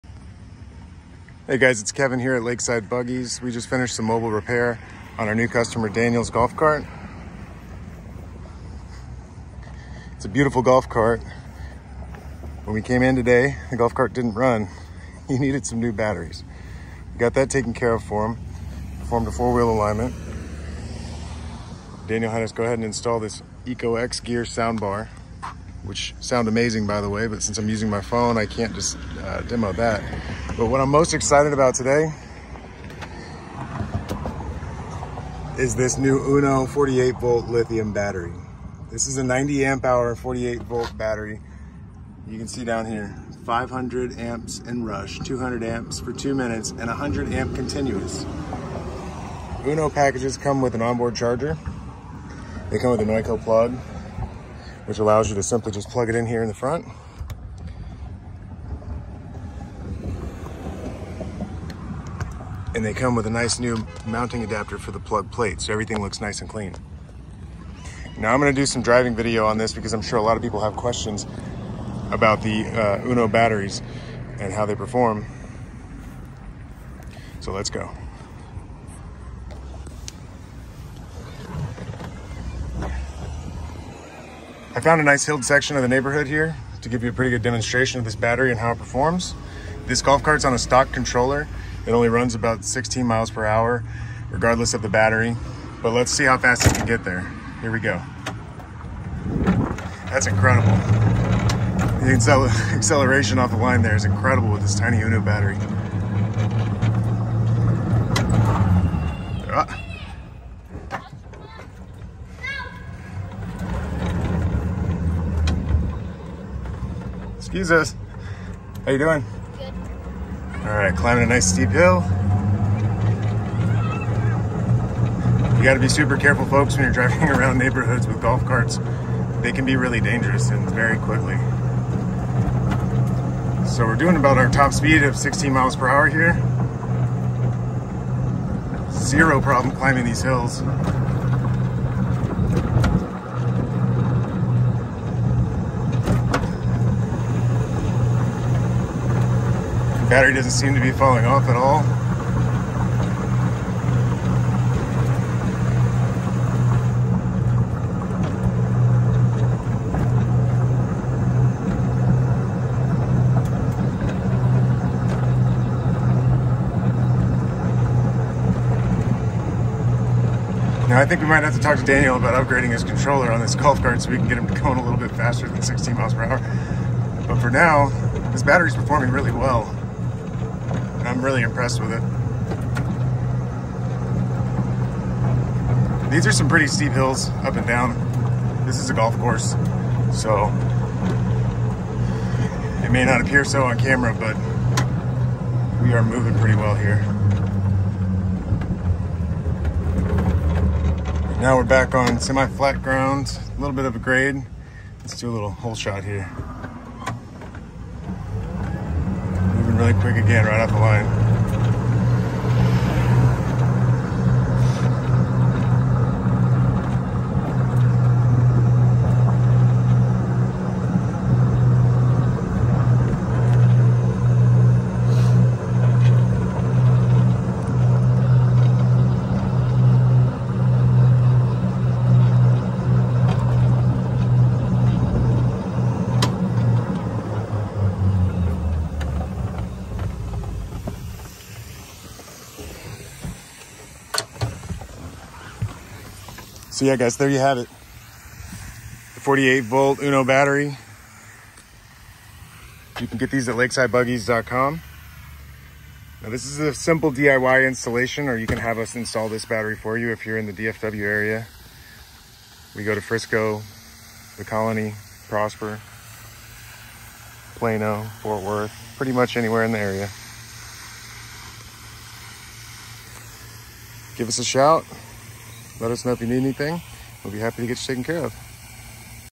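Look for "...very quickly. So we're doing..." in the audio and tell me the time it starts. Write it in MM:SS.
02:10.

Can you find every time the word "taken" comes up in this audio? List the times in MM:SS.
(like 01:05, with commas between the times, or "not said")
00:17, 04:37.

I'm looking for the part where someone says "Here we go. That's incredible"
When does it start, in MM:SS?
01:37.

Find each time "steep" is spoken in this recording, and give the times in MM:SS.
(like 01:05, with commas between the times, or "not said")
02:01, 03:06.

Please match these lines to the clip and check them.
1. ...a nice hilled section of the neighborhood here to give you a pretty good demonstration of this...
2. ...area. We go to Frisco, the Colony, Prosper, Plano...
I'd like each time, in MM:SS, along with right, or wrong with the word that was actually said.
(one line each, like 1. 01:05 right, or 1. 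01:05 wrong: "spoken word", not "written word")
1. 01:25 right
2. 04:21 right.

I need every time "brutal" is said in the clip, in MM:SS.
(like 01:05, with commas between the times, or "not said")
not said.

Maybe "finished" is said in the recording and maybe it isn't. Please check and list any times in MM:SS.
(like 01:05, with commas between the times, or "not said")
00:03.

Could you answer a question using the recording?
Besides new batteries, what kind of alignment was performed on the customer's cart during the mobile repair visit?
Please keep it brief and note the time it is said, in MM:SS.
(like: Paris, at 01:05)
Four-wheel alignment, at 00:19.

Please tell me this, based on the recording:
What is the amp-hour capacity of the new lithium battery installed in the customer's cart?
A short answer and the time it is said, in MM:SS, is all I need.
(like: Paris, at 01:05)
90 amp hour, at 00:39.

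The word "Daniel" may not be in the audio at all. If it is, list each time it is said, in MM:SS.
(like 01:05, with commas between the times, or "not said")
00:05, 00:22, 02:51.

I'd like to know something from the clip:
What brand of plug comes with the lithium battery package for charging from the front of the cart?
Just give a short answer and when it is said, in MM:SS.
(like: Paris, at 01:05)
NOCO, at 00:53.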